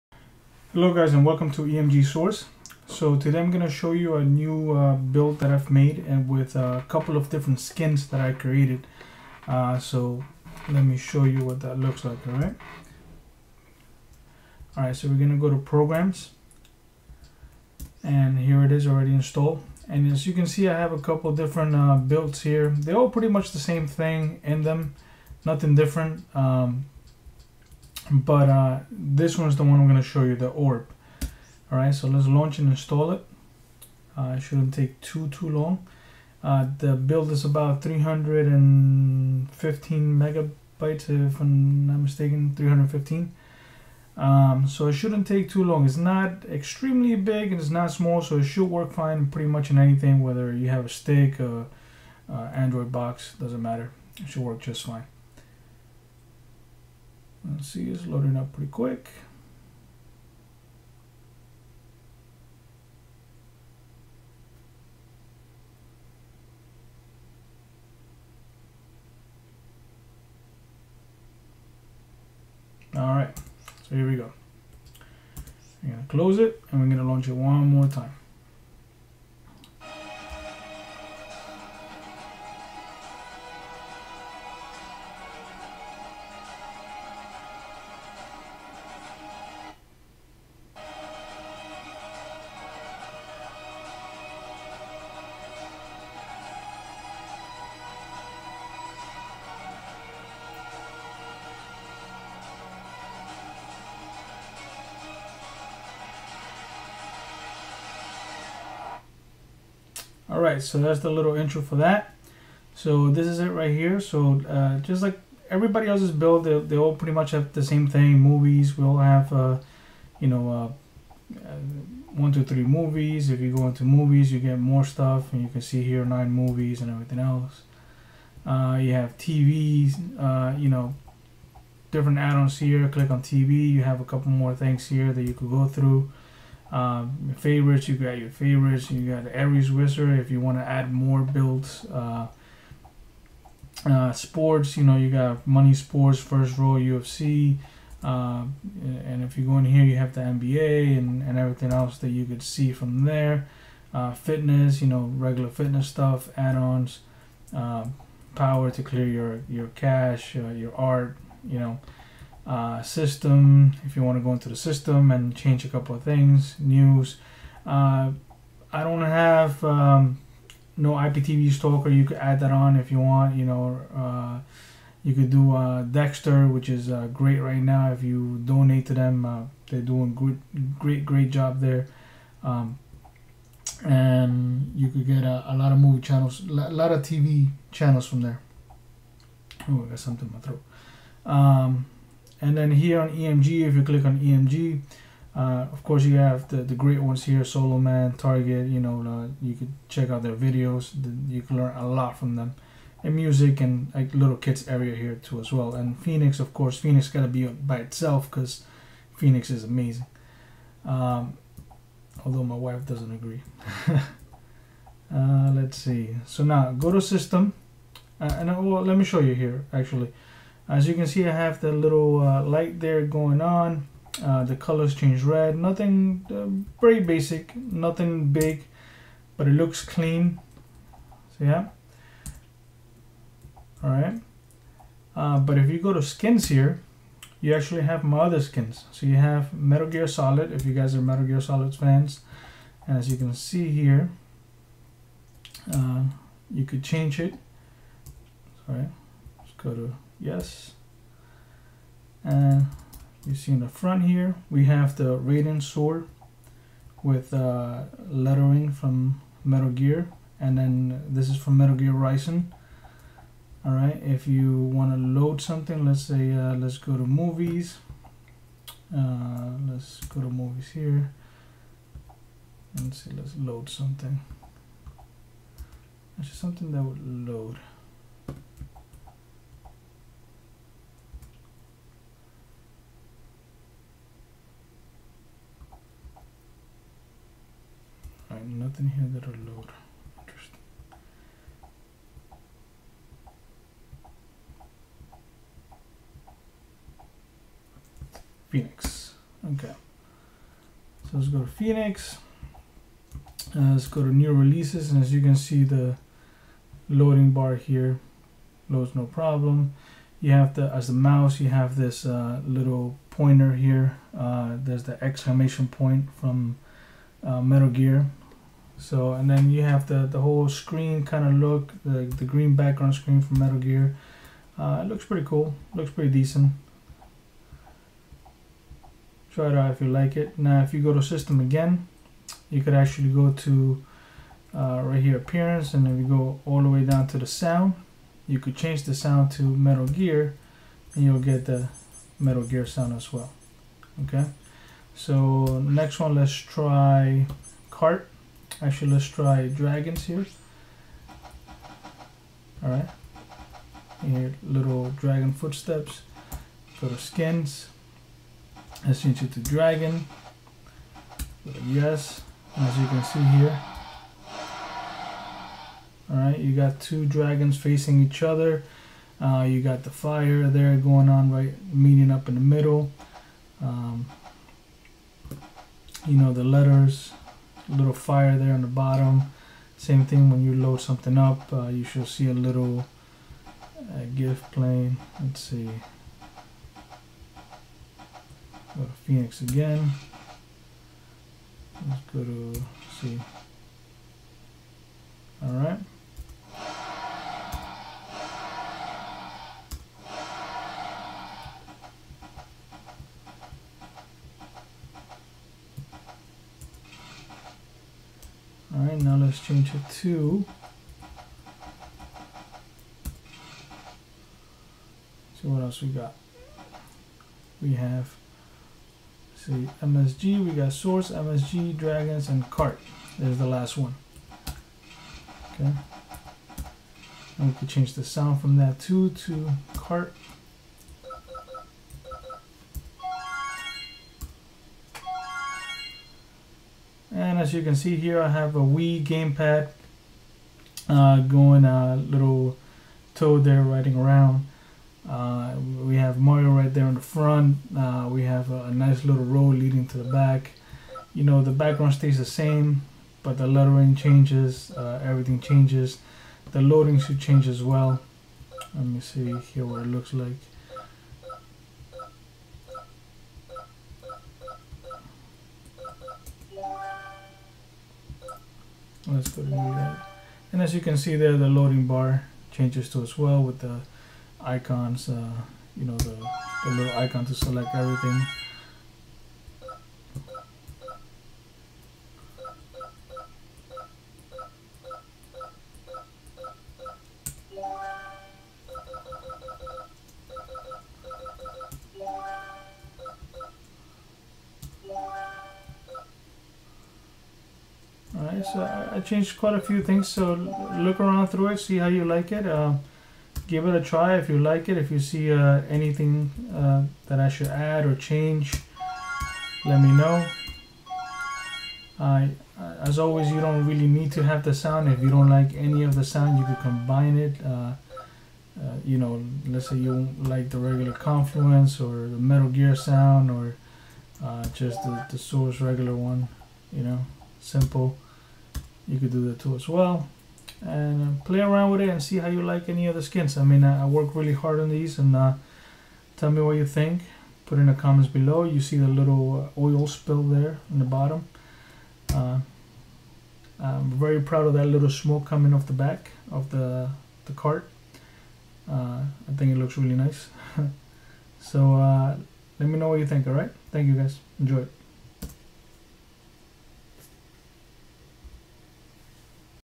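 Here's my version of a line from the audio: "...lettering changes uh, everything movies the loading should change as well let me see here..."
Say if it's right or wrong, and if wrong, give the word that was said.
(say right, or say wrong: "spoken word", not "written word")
wrong: "changes", not "movies".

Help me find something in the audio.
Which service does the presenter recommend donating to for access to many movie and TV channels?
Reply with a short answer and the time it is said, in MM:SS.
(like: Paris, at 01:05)
Dexter, at 02:55.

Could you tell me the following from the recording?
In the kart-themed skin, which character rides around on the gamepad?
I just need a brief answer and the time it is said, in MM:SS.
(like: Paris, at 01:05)
Toad, at 07:23.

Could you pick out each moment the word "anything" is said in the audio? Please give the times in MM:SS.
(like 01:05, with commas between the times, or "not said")
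00:49, 08:25.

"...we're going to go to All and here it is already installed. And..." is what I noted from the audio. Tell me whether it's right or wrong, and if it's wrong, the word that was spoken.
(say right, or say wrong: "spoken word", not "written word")
wrong: "Programs", not "All".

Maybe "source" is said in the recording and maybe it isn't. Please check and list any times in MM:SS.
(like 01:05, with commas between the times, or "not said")
00:02, 07:00, 08:45.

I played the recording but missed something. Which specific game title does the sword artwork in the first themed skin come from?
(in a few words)
Metal Gear Rising.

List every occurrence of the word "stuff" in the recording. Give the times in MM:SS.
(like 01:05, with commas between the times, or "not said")
02:04, 02:35.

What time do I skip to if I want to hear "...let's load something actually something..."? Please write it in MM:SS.
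04:33.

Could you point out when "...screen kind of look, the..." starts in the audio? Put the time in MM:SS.
05:20.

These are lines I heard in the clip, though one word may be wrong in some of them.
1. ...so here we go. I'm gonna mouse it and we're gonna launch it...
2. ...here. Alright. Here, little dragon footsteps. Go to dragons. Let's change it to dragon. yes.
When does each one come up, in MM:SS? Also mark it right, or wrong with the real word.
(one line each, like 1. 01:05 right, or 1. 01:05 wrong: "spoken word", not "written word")
1. 01:13 wrong: "close", not "mouse"
2. 05:50 wrong: "skins", not "dragons".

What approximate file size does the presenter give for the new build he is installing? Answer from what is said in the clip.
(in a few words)
315 megabytes.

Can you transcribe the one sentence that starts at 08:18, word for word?
I changed quite a few things, so look around through it, see how you like it.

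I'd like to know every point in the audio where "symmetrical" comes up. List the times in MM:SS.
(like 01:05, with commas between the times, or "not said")
not said.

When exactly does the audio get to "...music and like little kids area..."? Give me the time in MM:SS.
03:23.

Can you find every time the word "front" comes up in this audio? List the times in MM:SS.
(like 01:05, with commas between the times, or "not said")
04:13, 07:27.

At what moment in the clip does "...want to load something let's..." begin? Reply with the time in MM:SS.
04:24.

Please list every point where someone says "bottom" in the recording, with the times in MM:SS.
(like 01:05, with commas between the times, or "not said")
06:18, 09:00.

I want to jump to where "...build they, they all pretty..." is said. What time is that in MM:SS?
01:56.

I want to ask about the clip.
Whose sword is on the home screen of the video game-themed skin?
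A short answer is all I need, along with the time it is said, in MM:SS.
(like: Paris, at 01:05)
Raiden, at 04:15.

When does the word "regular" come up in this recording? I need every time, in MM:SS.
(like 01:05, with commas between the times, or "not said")
02:35, 08:40, 08:45.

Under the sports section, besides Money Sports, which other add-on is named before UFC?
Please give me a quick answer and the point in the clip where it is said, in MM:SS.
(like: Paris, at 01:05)
First Row, at 02:26.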